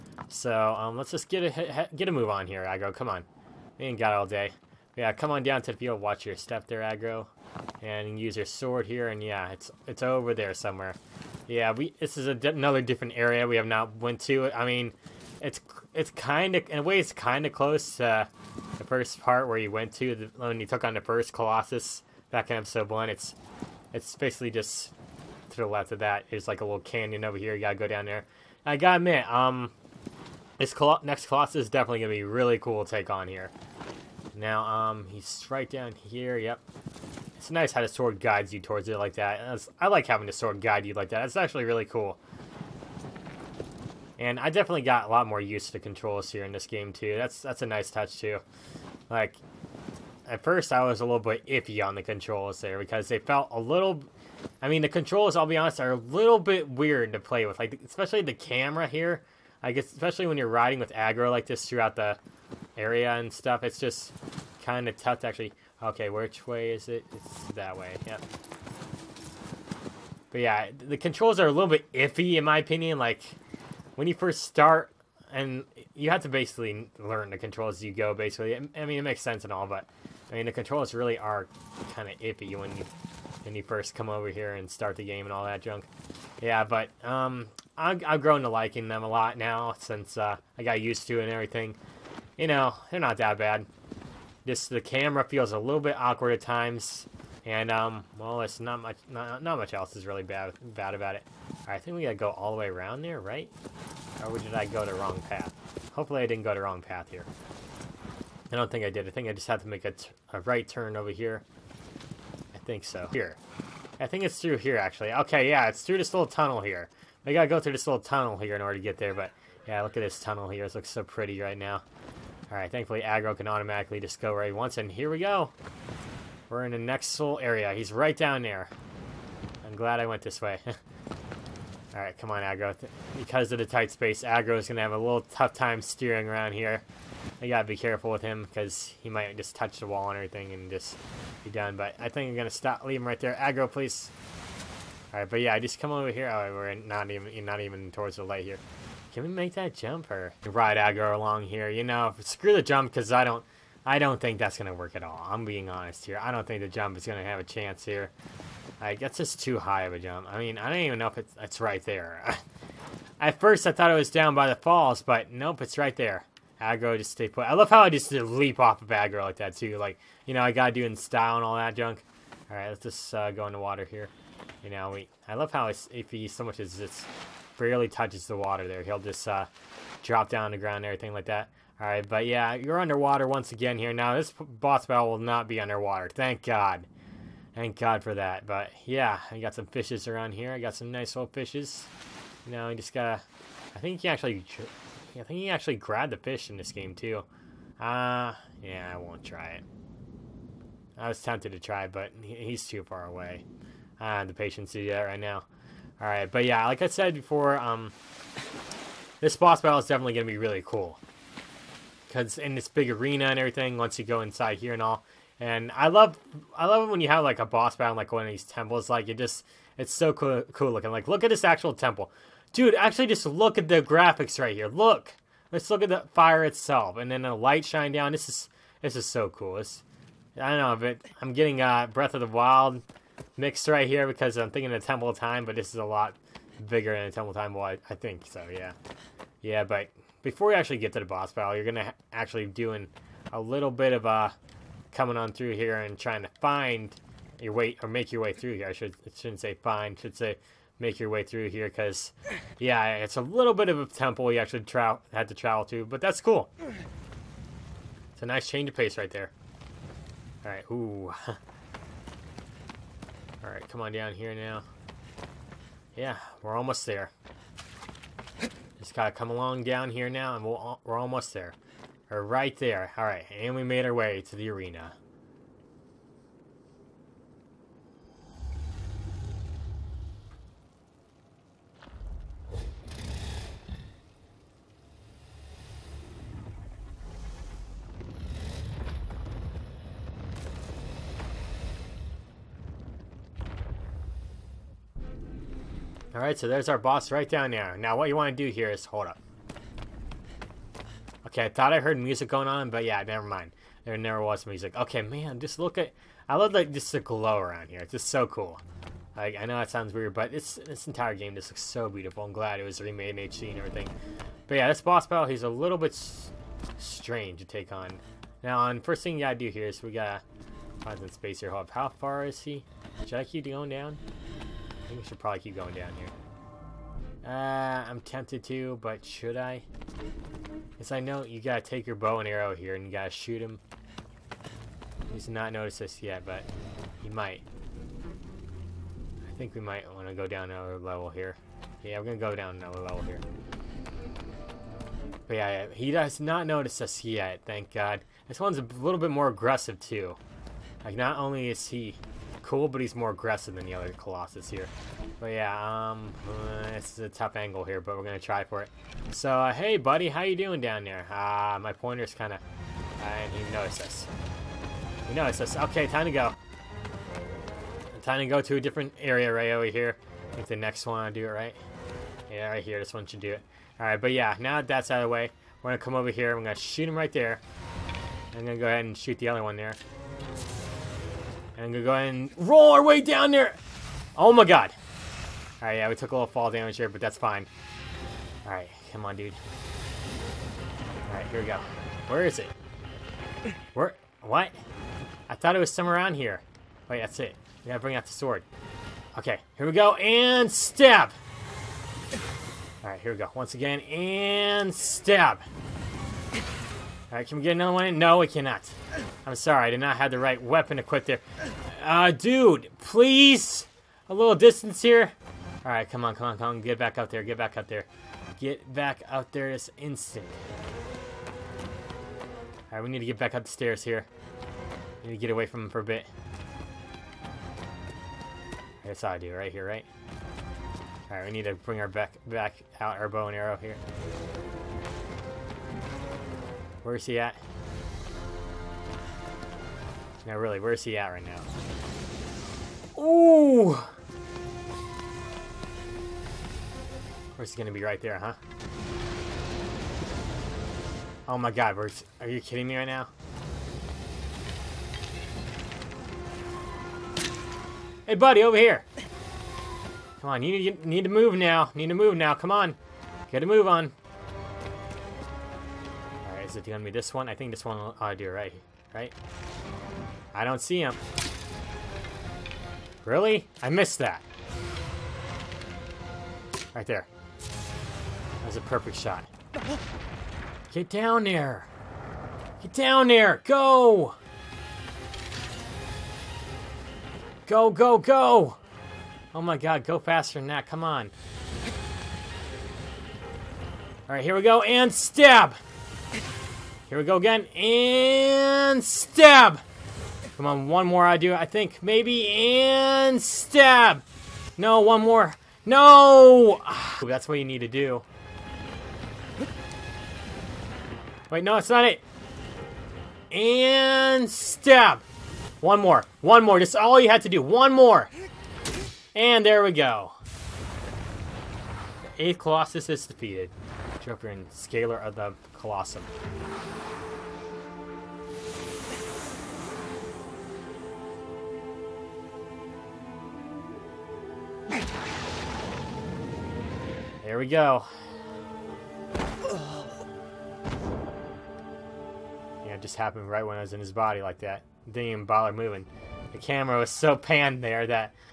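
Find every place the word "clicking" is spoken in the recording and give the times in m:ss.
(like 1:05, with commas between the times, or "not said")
not said.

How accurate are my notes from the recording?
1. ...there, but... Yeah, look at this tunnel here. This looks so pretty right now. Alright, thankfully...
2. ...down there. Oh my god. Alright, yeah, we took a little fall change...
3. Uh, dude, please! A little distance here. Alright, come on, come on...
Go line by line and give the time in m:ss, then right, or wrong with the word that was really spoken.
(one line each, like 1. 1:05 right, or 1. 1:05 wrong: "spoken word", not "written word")
1. 1:58 right
2. 6:22 wrong: "damage", not "change"
3. 6:51 right.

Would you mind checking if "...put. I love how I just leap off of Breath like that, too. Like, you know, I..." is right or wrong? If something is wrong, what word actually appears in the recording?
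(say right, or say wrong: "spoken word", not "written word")
wrong: "Agro", not "Breath".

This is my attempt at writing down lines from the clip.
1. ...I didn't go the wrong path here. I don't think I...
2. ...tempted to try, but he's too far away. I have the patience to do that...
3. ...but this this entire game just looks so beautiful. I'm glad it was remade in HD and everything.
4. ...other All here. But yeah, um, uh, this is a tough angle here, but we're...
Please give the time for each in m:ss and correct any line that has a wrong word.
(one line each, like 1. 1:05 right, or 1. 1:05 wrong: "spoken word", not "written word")
1. 1:46 right
2. 3:21 right
3. 5:10 right
4. 5:53 wrong: "Colossus", not "All".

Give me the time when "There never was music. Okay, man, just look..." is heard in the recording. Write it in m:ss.
5:03.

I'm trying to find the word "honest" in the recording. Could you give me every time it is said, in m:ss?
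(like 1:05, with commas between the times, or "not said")
0:55, 2:35.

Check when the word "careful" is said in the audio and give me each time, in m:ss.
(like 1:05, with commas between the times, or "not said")
2:17.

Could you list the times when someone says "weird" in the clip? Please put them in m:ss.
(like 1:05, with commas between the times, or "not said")
0:56, 5:09.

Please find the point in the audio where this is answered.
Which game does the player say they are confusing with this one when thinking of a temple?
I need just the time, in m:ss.
3:51.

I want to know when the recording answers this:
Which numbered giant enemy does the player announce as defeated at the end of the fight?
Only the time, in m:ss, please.
8:42.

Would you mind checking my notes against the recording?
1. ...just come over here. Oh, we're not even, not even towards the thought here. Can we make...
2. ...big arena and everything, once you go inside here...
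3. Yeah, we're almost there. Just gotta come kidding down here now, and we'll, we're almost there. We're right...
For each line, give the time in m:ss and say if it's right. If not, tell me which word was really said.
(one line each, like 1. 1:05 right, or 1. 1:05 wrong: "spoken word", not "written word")
1. 2:25 wrong: "light", not "thought"
2. 3:32 right
3. 4:25 wrong: "along", not "kidding".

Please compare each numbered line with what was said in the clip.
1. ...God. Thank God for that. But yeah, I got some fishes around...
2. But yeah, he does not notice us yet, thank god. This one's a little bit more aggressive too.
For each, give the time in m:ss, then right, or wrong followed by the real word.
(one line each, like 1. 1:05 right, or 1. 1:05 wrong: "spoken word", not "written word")
1. 3:06 right
2. 5:45 right.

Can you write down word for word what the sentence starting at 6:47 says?
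Alright, can we get another one No, we cannot.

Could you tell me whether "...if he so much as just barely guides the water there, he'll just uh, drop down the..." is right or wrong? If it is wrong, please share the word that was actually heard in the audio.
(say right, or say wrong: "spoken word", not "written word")
wrong: "touches", not "guides".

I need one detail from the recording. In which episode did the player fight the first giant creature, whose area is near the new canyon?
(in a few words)
Episode one.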